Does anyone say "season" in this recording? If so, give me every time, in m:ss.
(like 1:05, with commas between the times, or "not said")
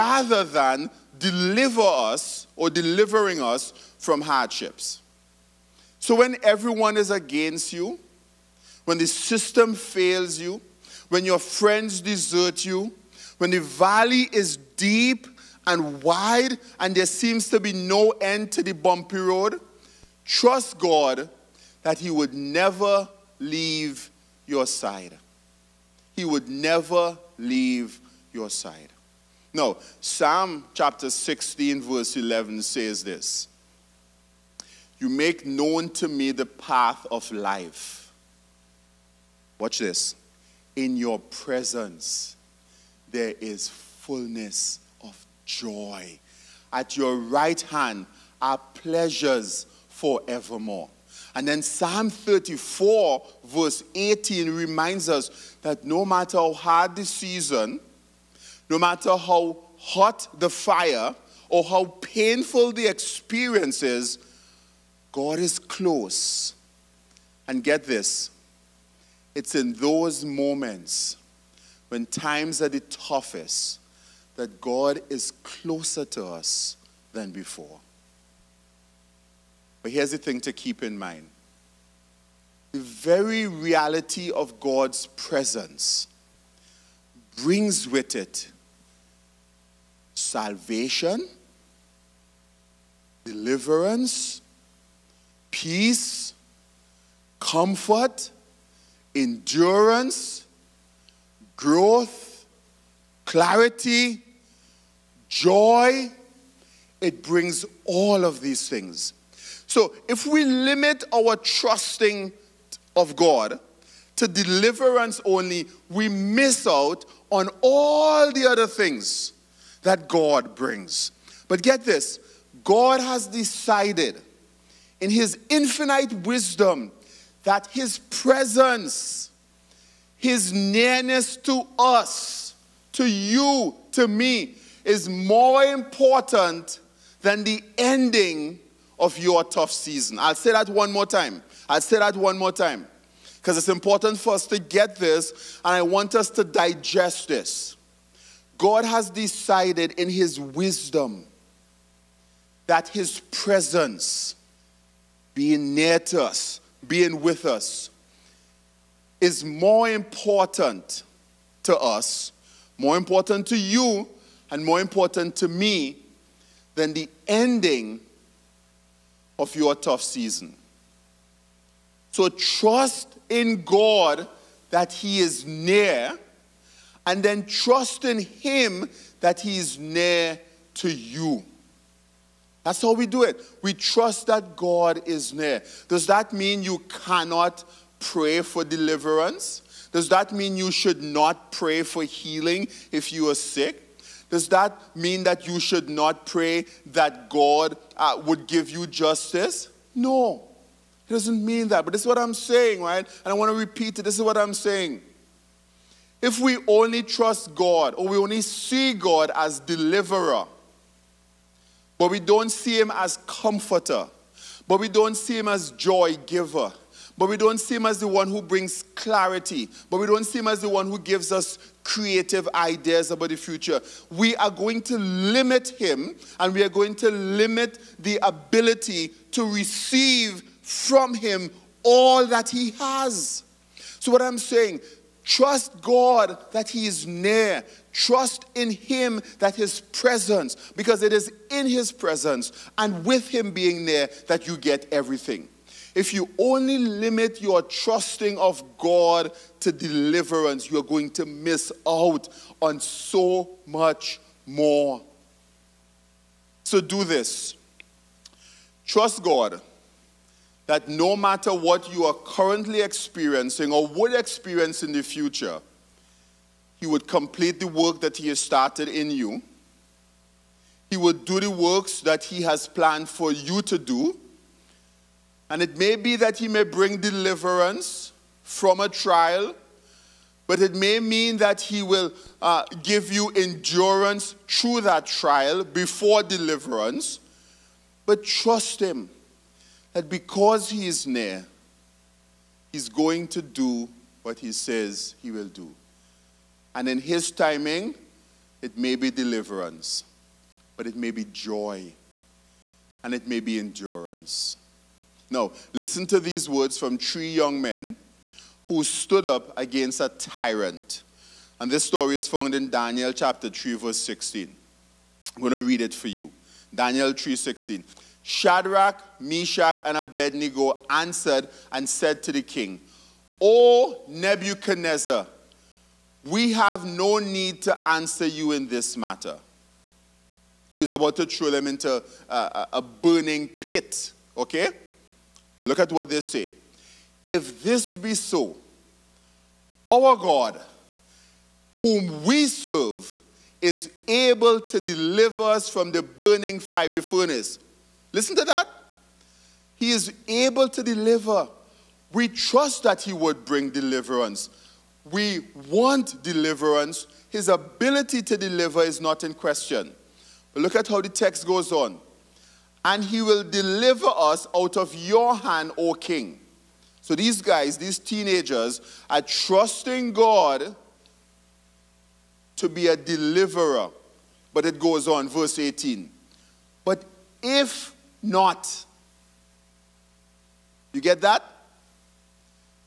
0:57, 2:19, 2:50.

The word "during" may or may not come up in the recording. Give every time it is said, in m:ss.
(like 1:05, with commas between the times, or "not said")
not said.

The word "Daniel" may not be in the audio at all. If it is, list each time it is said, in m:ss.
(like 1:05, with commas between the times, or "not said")
5:12, 5:16.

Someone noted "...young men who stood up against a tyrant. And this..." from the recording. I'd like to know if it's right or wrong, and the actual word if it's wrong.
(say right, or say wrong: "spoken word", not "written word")
right.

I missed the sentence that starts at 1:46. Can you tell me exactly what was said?
It brings all of these things.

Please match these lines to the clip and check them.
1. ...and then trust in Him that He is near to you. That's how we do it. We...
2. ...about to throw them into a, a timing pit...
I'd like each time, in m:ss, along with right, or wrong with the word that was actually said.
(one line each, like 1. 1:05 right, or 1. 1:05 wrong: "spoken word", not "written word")
1. 2:57 right
2. 5:30 wrong: "burning", not "timing".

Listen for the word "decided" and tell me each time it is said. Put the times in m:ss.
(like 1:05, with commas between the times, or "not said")
2:03, 2:29.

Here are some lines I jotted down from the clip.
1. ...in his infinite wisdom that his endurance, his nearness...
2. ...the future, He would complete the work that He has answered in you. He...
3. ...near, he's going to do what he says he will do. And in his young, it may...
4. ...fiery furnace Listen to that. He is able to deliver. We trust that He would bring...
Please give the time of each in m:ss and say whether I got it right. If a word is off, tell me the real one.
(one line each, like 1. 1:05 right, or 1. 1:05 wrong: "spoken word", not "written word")
1. 2:04 wrong: "presence", not "endurance"
2. 4:24 wrong: "started", not "answered"
3. 4:51 wrong: "timing", not "young"
4. 5:46 right.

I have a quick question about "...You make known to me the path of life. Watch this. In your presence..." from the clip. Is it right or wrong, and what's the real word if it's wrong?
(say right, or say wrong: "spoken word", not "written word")
right.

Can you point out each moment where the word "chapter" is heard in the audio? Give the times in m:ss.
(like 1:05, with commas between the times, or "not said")
0:30, 5:13.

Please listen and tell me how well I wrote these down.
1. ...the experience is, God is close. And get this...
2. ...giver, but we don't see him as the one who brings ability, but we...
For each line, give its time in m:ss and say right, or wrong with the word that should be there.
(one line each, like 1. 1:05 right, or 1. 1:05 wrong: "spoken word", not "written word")
1. 1:02 right
2. 3:36 wrong: "clarity", not "ability".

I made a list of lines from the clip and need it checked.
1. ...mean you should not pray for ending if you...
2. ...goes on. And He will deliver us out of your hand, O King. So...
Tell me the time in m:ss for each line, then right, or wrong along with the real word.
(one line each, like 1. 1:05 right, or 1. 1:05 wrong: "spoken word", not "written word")
1. 3:10 wrong: "healing", not "ending"
2. 6:01 right.